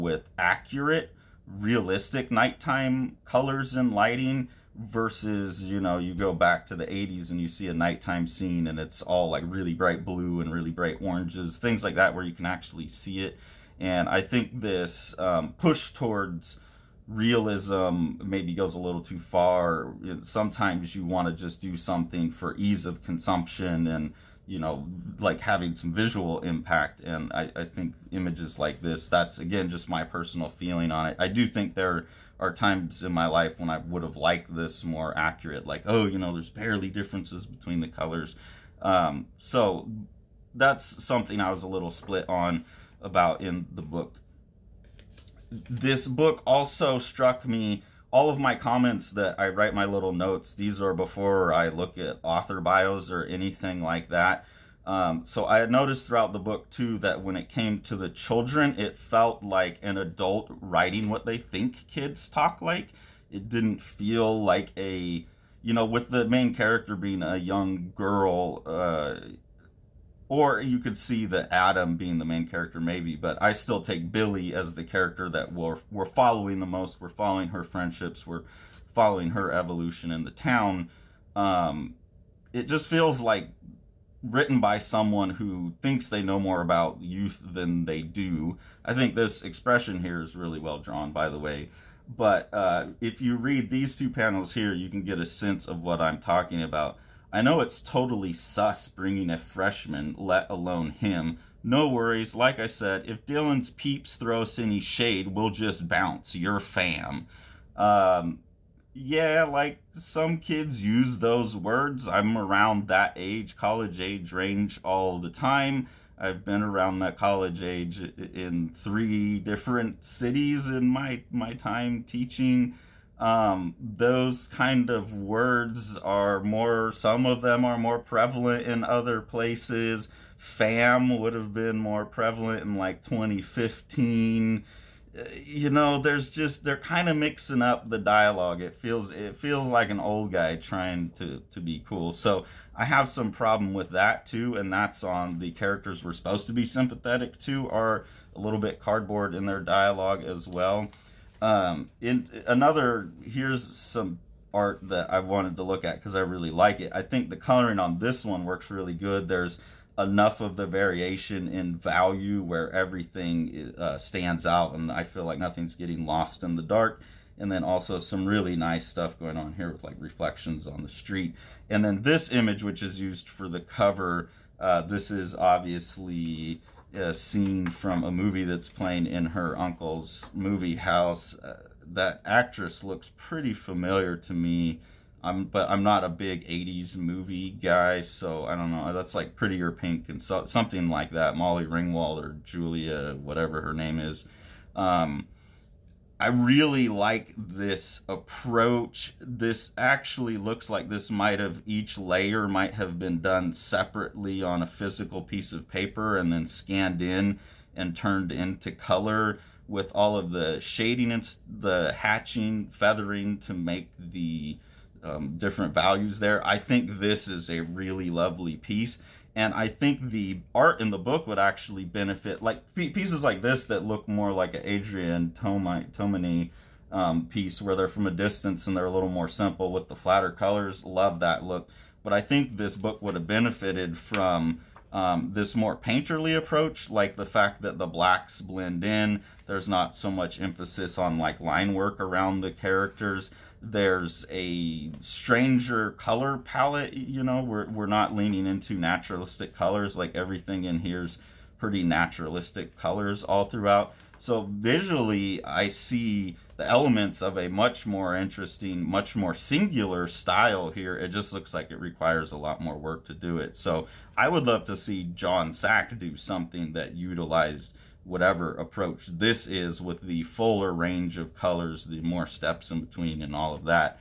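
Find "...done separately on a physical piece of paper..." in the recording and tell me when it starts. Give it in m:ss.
3:23.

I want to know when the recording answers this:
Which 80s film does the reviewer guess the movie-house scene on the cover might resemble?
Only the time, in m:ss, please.
3:09.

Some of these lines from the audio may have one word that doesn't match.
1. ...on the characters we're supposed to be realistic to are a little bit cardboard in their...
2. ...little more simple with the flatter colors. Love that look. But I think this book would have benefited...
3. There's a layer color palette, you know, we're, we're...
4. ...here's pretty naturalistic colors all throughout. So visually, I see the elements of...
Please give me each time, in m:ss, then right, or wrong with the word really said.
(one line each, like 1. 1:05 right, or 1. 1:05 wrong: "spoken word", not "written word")
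1. 2:25 wrong: "sympathetic", not "realistic"
2. 3:48 right
3. 4:03 wrong: "stranger", not "layer"
4. 4:10 right.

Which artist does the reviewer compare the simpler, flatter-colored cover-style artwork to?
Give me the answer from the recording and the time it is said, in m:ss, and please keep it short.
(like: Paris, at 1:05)
Adrian Tomine, at 3:44.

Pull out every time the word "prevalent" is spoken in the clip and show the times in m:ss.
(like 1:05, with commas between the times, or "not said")
2:07, 2:12.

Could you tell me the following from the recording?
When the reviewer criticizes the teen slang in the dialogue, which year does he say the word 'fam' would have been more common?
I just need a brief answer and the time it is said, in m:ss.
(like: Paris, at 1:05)
2015, at 2:13.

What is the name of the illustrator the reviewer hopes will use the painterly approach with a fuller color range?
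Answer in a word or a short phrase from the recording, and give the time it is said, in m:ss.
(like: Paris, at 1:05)
Jon Sack, at 4:25.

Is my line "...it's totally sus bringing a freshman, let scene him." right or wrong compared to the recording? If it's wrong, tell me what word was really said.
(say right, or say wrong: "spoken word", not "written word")
wrong: "alone", not "scene".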